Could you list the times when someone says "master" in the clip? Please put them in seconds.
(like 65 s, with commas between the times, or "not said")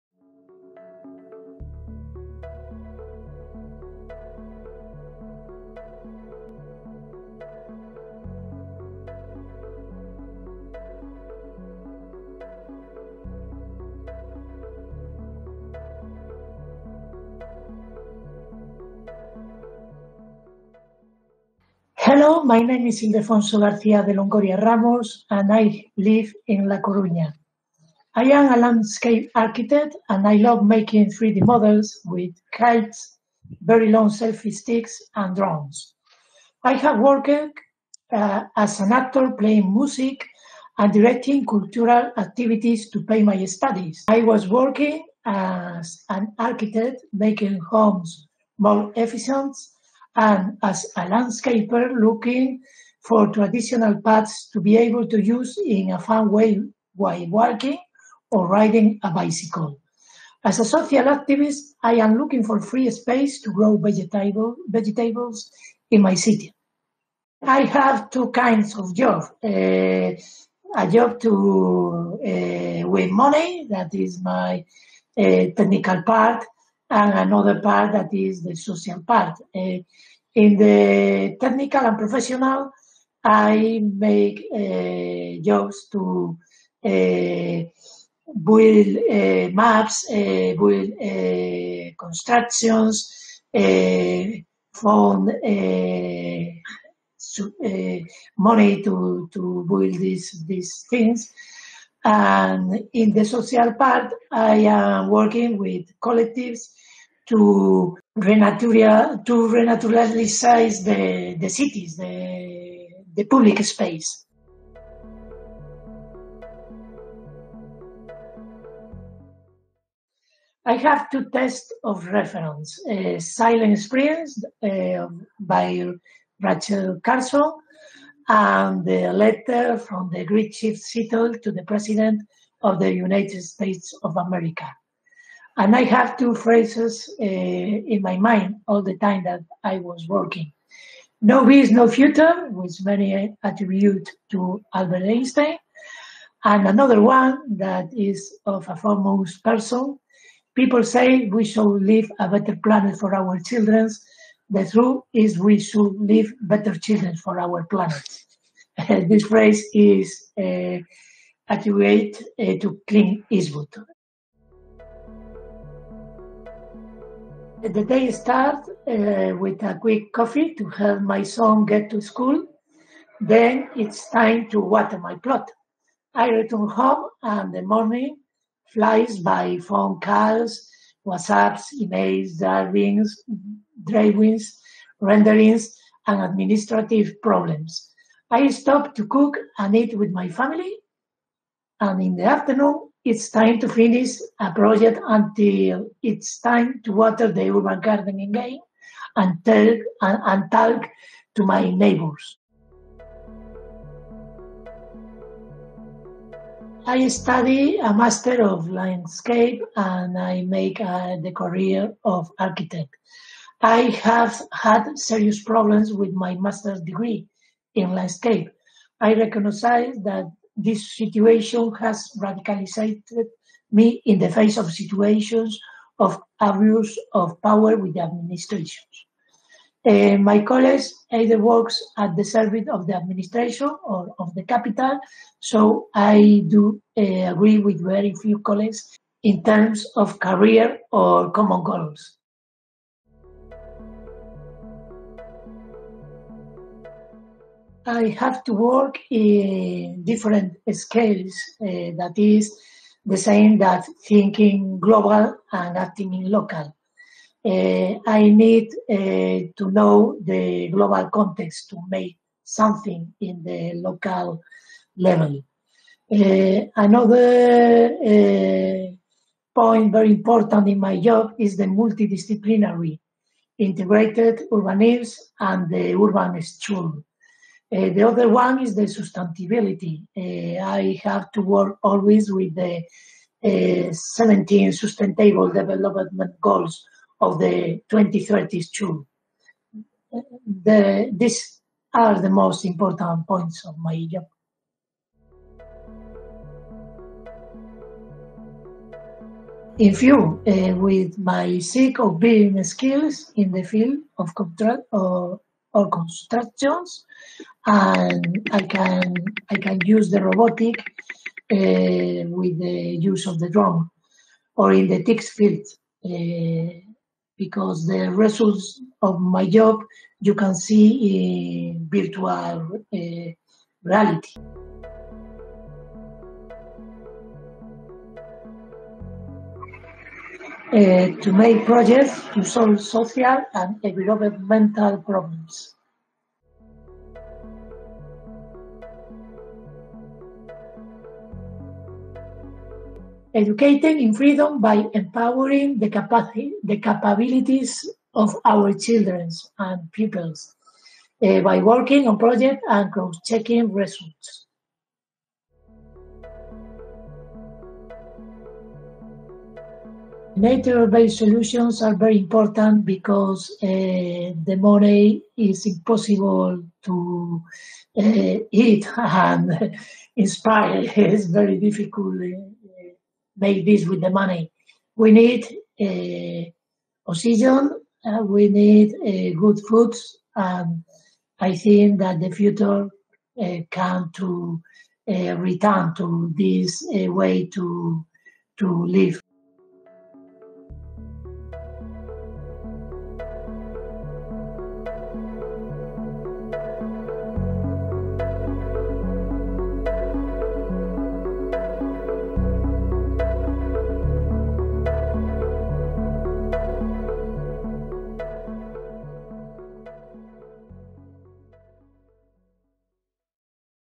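207 s, 216 s.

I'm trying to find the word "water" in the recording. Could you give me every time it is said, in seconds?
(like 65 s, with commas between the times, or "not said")
174 s, 196 s.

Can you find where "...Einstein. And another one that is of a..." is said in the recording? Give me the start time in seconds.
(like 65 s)
145 s.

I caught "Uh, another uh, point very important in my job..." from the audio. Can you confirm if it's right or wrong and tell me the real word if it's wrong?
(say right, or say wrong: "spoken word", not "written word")
right.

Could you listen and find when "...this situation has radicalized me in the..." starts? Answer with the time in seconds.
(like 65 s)
220 s.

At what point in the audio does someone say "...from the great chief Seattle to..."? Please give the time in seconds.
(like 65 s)
129 s.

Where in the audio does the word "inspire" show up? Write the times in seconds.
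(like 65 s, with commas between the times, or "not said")
370 s.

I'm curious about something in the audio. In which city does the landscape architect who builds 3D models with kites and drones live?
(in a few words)
La Coruña.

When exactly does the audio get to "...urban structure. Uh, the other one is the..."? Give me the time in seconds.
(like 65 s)
275 s.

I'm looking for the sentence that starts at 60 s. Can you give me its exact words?
As a social activist, I am looking for free space to grow vegetable, vegetables in my city.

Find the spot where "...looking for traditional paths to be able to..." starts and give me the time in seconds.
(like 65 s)
51 s.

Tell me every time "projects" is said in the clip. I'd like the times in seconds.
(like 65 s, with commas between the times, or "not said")
194 s, 331 s, 352 s.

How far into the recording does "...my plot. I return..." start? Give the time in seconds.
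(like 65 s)
174 s.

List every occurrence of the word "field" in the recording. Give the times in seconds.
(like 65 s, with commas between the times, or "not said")
303 s, 315 s.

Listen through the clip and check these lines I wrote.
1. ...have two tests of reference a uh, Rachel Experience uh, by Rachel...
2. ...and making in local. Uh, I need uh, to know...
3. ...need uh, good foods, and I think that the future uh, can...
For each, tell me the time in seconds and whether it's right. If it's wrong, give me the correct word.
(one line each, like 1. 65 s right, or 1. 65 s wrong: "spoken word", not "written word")
1. 120 s wrong: "Silent", not "Rachel"
2. 255 s wrong: "acting", not "making"
3. 378 s right.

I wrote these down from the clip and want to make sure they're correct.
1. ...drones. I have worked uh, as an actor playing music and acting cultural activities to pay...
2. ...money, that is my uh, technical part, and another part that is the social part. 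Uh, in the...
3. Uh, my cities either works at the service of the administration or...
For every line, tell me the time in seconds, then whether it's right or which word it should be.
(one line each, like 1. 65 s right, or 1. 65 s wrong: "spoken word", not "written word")
1. 35 s wrong: "directing", not "acting"
2. 73 s right
3. 229 s wrong: "colleagues", not "cities".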